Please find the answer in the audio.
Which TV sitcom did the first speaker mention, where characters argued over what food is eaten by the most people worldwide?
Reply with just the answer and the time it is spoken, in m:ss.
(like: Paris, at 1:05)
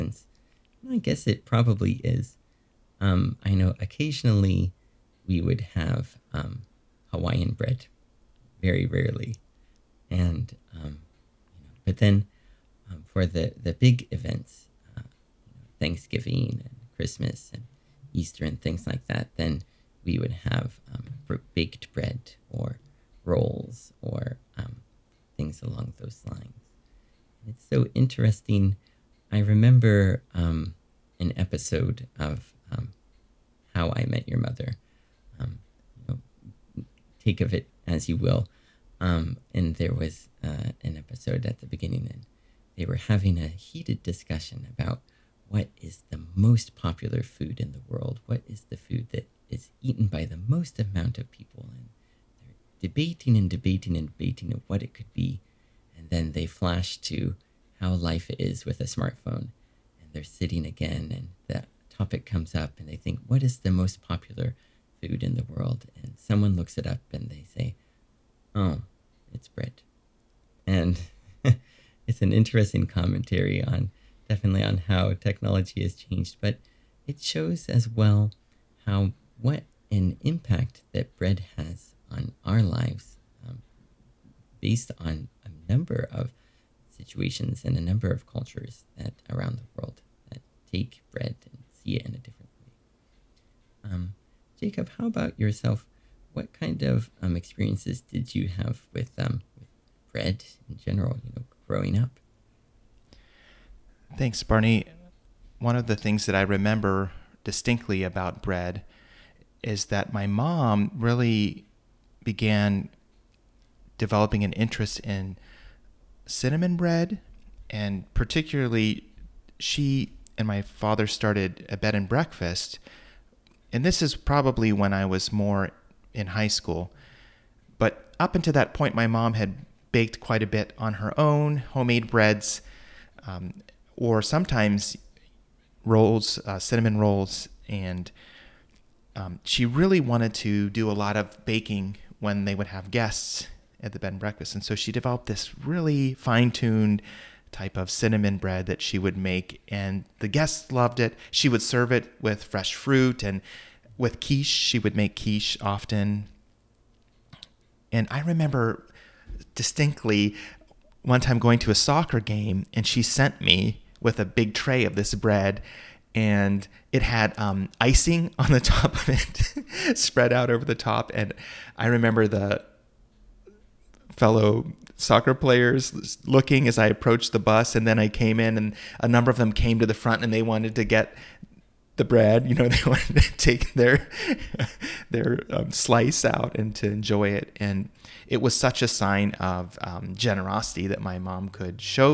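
How I Met Your Mother, at 0:33.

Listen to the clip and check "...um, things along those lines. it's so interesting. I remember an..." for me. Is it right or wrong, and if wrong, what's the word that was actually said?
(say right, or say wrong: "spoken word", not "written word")
right.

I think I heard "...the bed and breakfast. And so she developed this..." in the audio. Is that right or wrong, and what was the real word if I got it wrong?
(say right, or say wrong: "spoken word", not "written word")
right.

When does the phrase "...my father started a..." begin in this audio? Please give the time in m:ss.
2:00.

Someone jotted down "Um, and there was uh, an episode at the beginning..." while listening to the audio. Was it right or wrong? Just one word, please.
right.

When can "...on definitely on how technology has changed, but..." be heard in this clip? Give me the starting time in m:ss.
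1:13.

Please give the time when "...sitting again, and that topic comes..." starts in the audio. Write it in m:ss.
1:00.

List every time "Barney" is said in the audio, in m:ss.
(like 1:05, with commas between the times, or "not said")
1:44.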